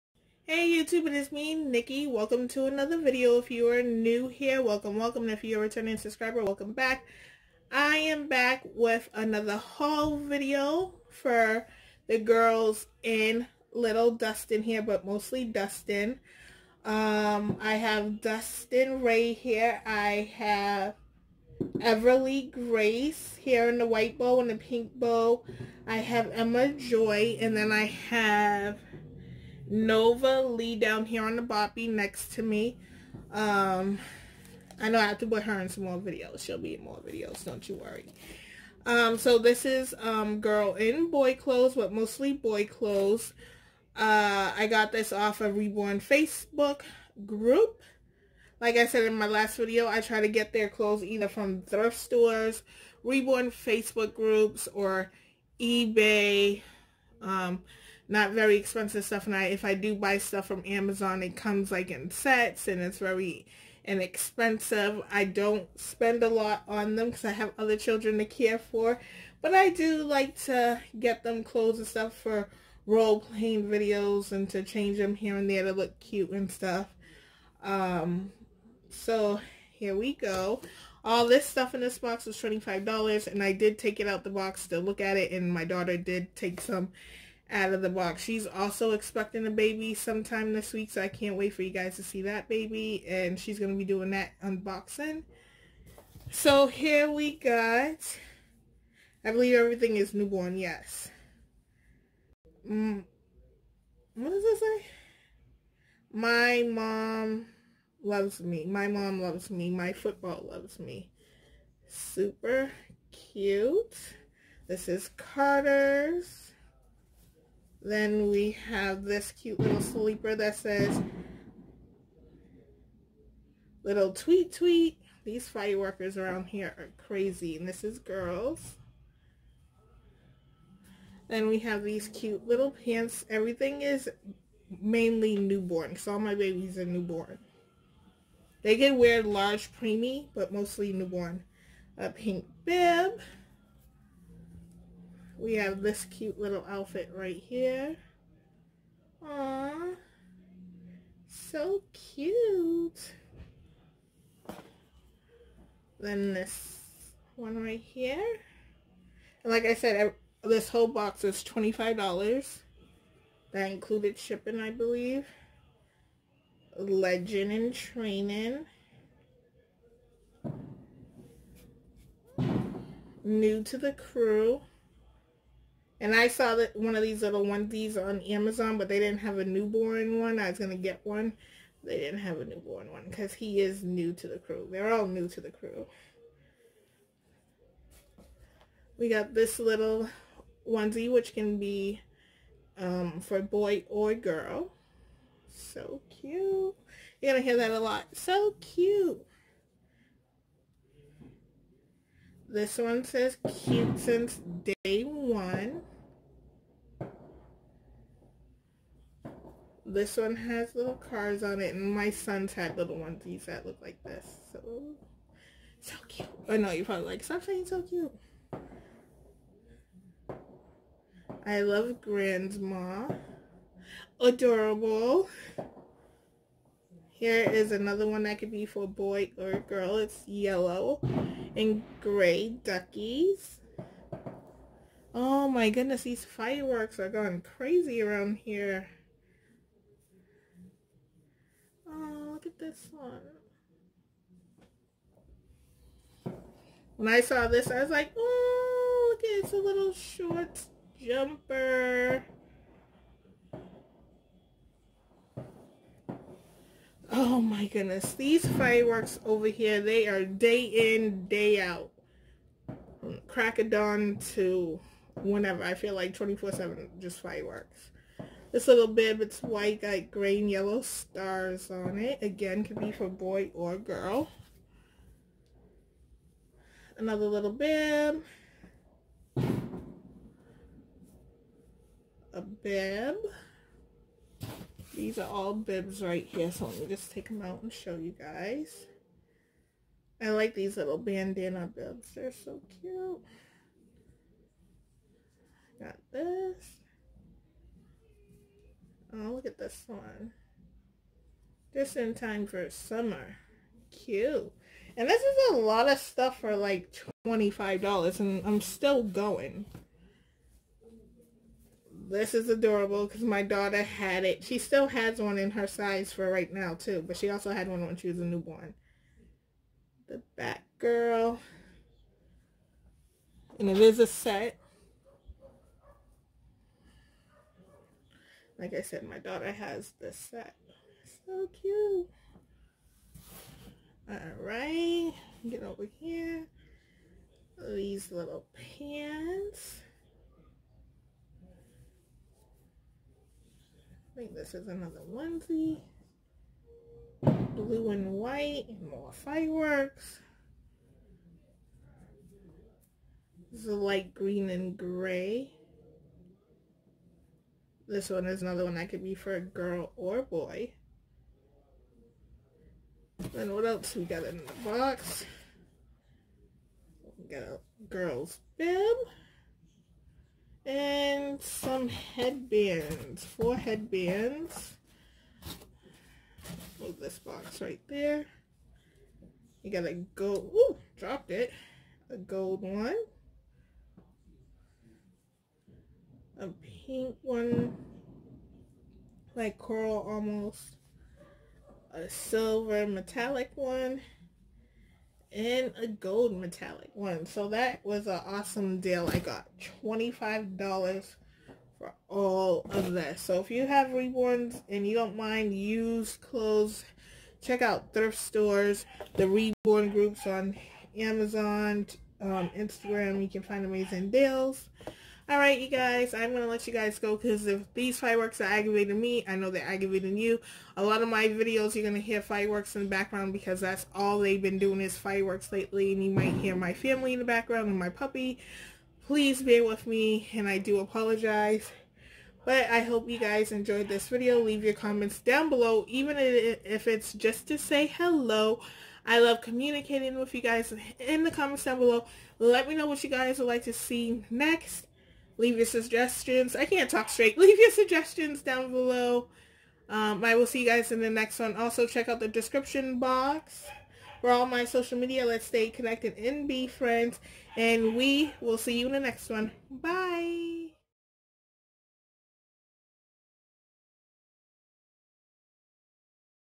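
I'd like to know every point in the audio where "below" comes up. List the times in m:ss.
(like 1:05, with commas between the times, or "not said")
7:15, 7:21, 7:28.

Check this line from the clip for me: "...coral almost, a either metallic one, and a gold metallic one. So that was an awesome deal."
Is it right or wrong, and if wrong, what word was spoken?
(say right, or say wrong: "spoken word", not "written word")
wrong: "silver", not "either".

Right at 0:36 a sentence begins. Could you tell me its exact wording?
She'll be in more videos, don't you worry.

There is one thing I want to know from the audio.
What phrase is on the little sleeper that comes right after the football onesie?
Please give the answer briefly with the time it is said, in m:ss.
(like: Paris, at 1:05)
little tweet tweet, at 2:03.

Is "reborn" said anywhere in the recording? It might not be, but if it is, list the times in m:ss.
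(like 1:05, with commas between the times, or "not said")
0:45, 0:53, 6:43, 6:49.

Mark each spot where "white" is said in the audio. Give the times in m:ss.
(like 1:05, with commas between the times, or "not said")
0:23, 4:29, 5:48.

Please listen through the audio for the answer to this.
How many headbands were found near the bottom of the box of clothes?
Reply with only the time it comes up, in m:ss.
6:13.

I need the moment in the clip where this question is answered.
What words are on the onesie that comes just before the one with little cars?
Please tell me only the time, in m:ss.
3:23.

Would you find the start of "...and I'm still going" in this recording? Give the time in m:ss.
5:08.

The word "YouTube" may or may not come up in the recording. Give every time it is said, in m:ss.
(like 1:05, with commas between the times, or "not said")
0:00.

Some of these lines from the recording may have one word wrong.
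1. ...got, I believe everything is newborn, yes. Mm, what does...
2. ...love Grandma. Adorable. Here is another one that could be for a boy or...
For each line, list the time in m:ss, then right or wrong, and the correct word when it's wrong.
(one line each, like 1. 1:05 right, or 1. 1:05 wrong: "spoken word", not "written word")
1. 1:37 right
2. 3:41 right.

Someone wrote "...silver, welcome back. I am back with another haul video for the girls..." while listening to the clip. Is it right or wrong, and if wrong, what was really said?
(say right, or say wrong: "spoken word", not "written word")
wrong: "subscriber", not "silver".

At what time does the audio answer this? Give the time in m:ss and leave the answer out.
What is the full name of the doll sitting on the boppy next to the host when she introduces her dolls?
0:29.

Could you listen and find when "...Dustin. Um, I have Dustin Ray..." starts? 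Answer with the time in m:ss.
0:15.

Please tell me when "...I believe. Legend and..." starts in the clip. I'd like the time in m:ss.
2:44.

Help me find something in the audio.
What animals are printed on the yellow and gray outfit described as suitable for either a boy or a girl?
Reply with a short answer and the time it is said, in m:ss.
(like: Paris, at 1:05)
duckies, at 3:52.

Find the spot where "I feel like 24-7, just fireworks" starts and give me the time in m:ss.
4:25.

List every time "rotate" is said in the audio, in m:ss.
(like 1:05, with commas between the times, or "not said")
not said.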